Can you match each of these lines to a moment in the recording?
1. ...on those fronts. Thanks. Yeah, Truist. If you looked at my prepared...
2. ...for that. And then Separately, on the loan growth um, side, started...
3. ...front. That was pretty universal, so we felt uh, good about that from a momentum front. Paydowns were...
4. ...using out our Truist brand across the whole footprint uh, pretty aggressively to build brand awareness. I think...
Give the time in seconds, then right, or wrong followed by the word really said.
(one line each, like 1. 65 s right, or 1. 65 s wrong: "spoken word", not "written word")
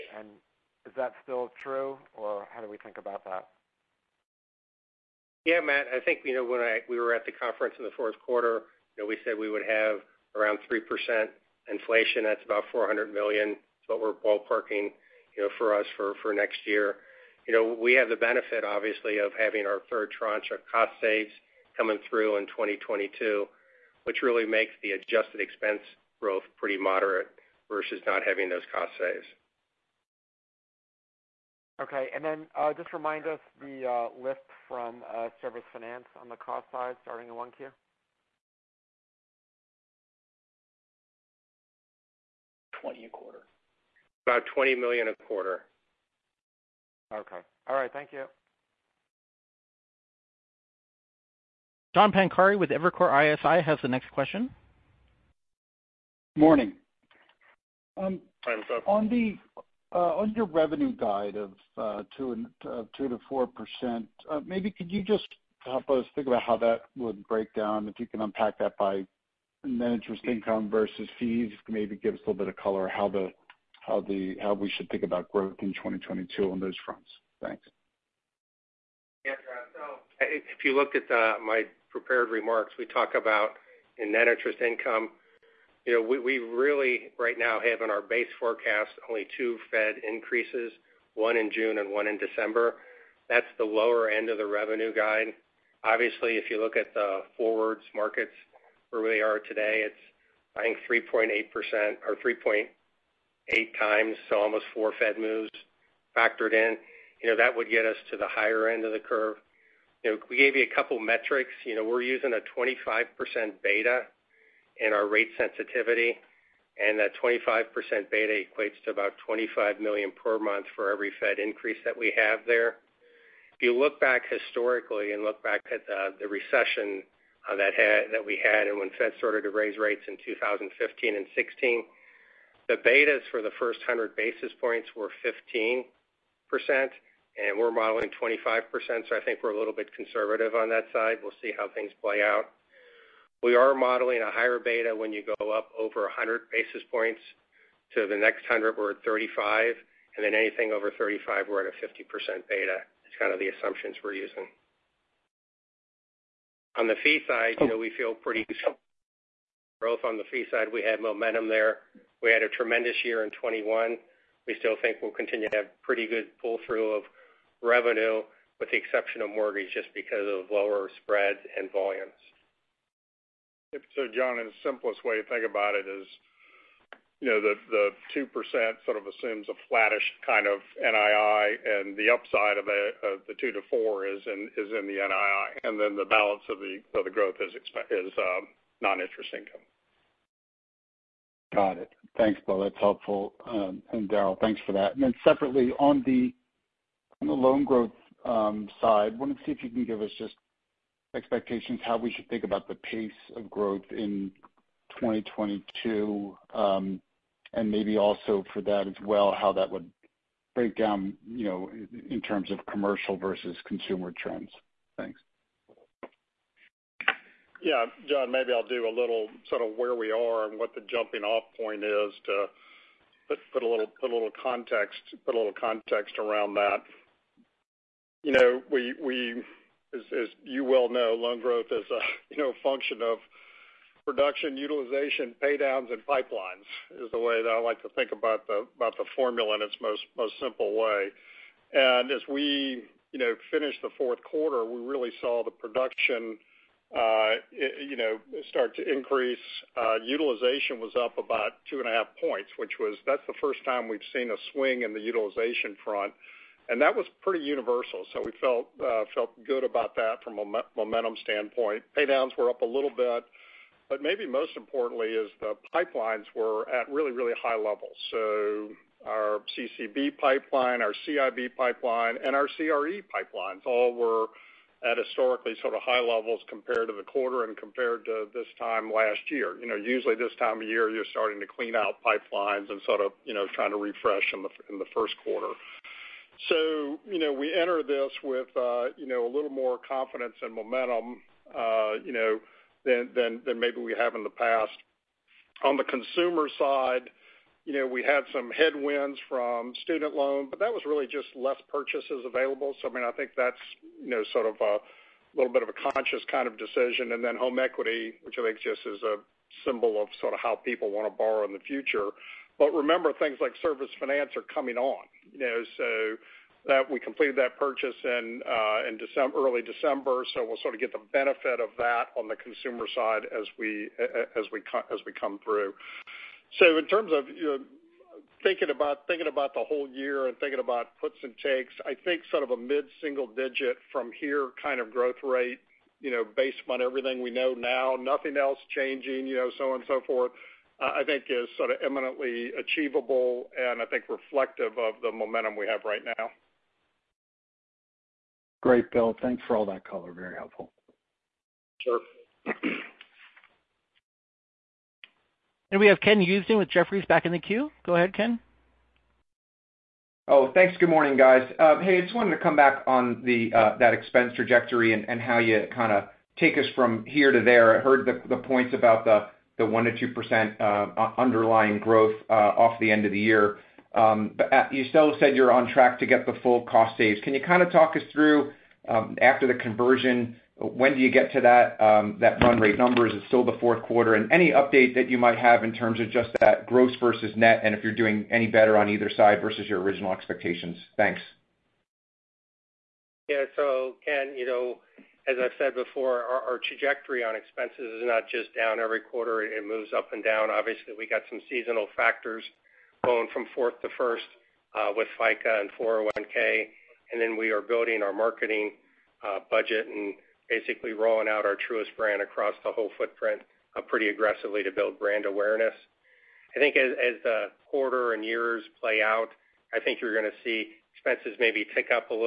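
1. 76 s wrong: "Rob", not "Truist"
2. 194 s wrong: "wanted", not "started"
3. 255 s wrong: "standpoint", not "front"
4. 410 s wrong: "rolling", not "using".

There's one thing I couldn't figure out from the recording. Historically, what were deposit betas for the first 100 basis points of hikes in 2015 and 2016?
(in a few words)
15%.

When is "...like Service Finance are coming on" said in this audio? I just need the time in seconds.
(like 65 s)
313 s.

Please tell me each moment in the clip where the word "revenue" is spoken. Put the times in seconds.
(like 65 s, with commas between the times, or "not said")
60 s, 94 s, 167 s.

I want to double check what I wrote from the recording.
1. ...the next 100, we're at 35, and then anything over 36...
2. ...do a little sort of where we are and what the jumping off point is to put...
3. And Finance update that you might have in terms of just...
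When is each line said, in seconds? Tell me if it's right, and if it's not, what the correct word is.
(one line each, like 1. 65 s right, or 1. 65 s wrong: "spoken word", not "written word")
1. 148 s wrong: "35", not "36"
2. 218 s right
3. 384 s wrong: "Any", not "Finance".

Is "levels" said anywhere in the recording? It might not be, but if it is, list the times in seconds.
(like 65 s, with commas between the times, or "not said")
267 s, 276 s.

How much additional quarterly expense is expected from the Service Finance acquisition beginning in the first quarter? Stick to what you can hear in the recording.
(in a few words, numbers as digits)
$20 million.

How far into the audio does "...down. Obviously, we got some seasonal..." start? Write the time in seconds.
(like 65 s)
400 s.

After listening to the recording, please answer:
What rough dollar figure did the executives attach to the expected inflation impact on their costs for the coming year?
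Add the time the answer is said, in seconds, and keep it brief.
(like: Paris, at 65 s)
$400 million, at 12 s.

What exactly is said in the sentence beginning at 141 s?
We'll see how things play out.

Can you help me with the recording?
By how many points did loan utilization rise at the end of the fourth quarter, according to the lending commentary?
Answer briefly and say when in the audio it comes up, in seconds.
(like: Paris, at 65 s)
2.5 points, at 251 s.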